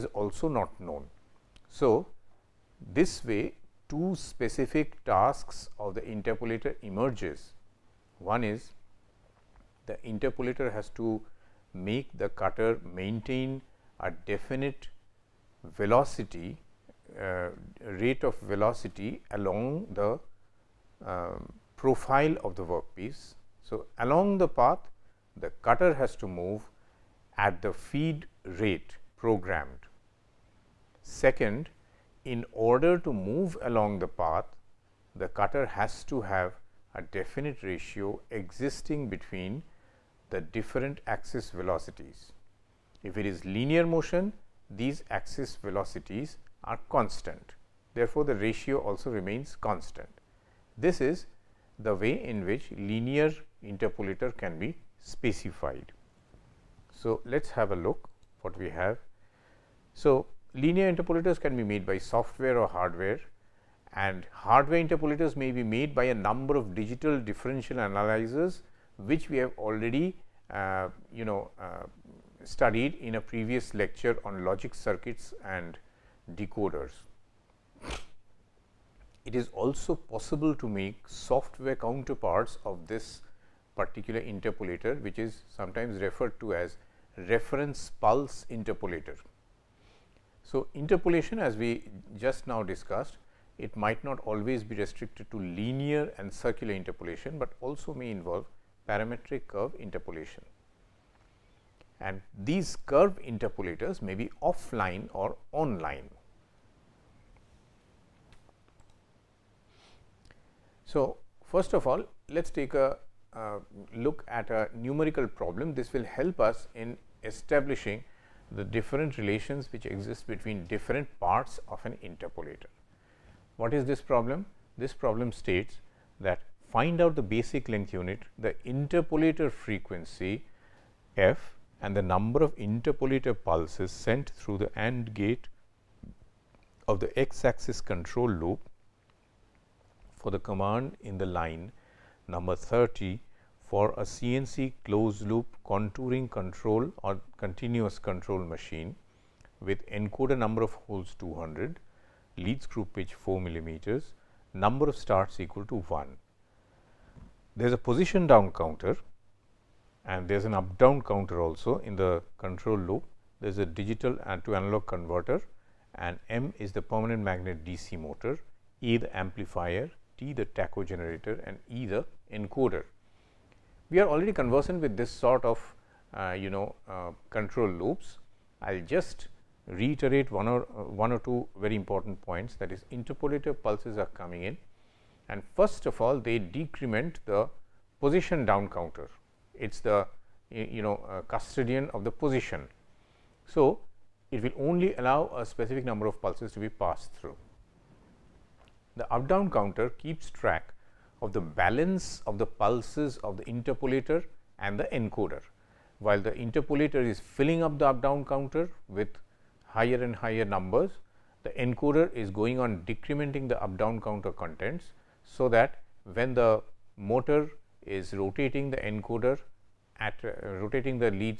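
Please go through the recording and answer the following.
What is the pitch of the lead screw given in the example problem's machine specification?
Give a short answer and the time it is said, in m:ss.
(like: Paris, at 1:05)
4 millimeters, at 2:33.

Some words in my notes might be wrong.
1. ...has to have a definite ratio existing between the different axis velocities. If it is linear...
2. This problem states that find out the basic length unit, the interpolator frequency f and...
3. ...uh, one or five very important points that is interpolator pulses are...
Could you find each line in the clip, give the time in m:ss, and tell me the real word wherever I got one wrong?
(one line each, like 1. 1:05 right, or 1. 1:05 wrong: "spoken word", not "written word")
1. 0:35 right
2. 2:04 right
3. 3:00 wrong: "two", not "five".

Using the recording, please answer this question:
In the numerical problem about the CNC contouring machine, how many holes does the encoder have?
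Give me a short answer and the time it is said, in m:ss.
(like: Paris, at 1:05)
200, at 2:31.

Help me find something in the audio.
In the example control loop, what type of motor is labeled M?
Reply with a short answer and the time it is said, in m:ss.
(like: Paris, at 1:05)
permanent magnet DC motor, at 2:46.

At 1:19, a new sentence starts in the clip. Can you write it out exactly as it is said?
It is also possible to make software counterparts of this particular interpolator which is sometimes referred to as reference pulse interpolator.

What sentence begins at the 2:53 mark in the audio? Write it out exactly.
We are already conversant with this sort of uh, you know uh, control loops.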